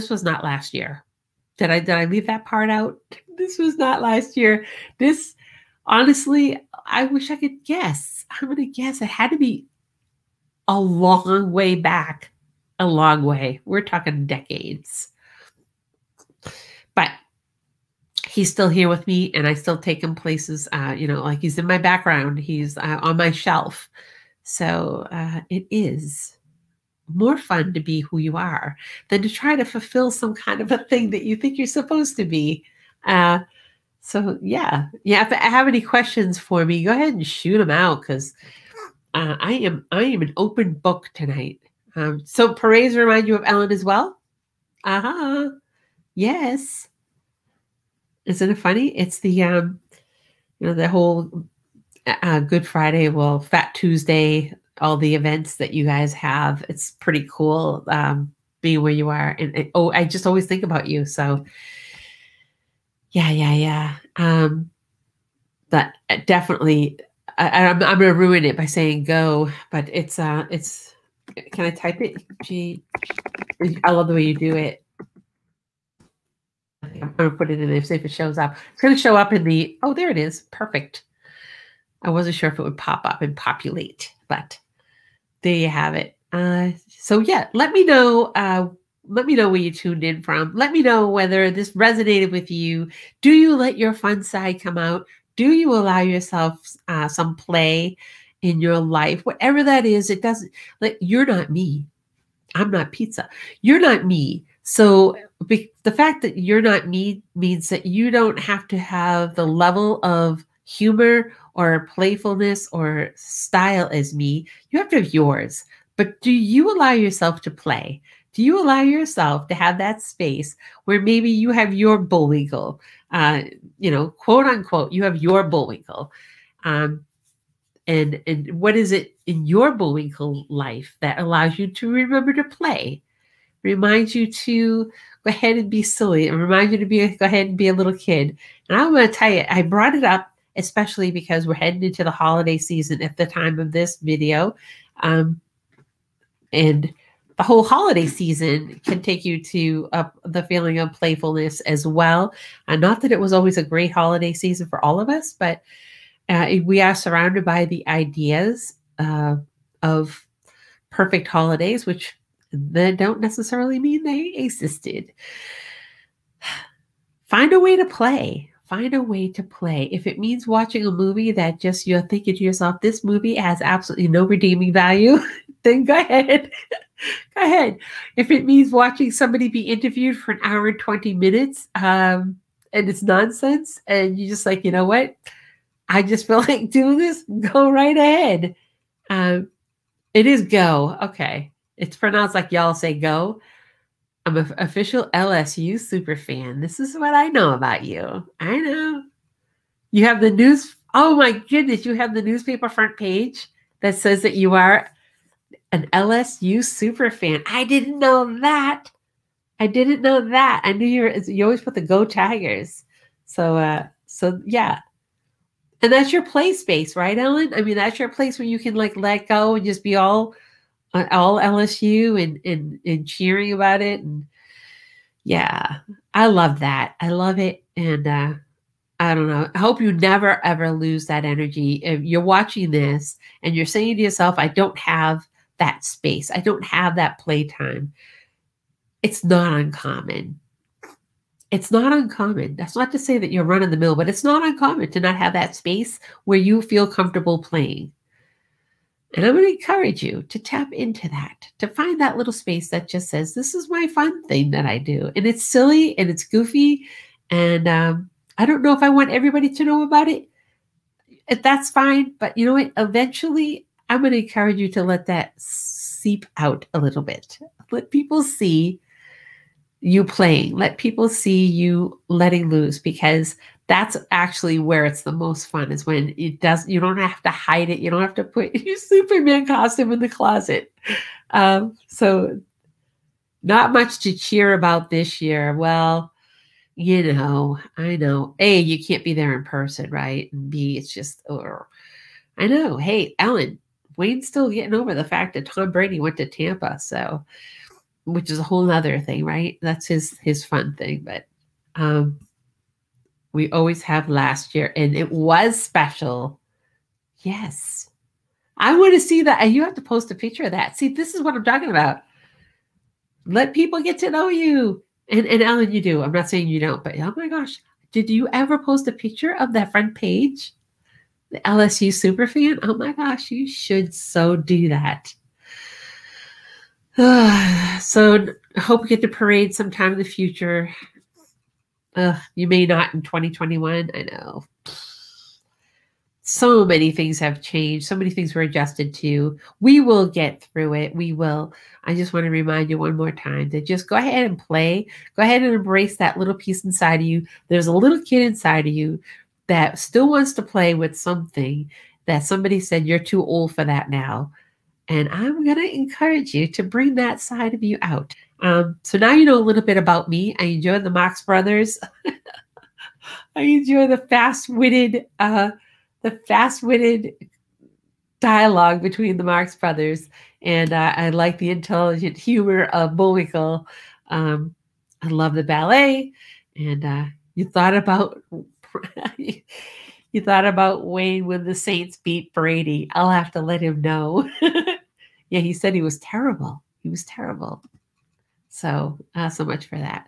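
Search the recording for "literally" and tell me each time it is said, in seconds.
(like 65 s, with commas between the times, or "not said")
not said.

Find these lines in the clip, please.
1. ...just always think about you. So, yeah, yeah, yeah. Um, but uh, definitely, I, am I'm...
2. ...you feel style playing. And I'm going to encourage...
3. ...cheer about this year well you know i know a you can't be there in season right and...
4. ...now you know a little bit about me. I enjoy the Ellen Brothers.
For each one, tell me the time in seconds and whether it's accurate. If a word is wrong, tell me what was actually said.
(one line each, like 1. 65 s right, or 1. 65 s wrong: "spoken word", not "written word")
1. 60 s right
2. 246 s wrong: "comfortable", not "style"
3. 284 s wrong: "person", not "season"
4. 358 s wrong: "Marx", not "Ellen".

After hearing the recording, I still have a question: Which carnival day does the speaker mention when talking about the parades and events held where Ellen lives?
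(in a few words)
Fat Tuesday.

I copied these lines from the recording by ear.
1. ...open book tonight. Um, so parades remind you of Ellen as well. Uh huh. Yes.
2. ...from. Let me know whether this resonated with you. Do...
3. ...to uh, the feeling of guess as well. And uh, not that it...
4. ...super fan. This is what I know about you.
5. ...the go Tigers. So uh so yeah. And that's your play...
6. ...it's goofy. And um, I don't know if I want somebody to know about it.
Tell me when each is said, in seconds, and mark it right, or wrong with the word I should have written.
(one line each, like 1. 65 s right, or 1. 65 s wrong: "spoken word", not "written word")
1. 40 s right
2. 90 s right
3. 149 s wrong: "playfulness", not "guess"
4. 195 s right
5. 211 s right
6. 256 s wrong: "everybody", not "somebody".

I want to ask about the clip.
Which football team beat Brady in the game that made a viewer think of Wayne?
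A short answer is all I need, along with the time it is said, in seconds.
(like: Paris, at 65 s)
Saints, at 381 s.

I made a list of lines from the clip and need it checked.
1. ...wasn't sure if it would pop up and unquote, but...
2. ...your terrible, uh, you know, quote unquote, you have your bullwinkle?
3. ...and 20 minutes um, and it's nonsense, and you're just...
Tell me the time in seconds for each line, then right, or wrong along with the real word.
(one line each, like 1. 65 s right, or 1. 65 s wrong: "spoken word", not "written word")
1. 82 s wrong: "populate", not "unquote"
2. 121 s wrong: "bullwinkle", not "terrible"
3. 180 s right.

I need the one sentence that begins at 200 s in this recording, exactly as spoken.
Oh my goodness, you have the newspaper front page that says that you are an LSU super fan.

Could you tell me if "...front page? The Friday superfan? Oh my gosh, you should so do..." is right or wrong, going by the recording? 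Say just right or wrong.
wrong.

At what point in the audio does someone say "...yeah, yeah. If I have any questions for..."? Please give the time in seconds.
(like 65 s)
34 s.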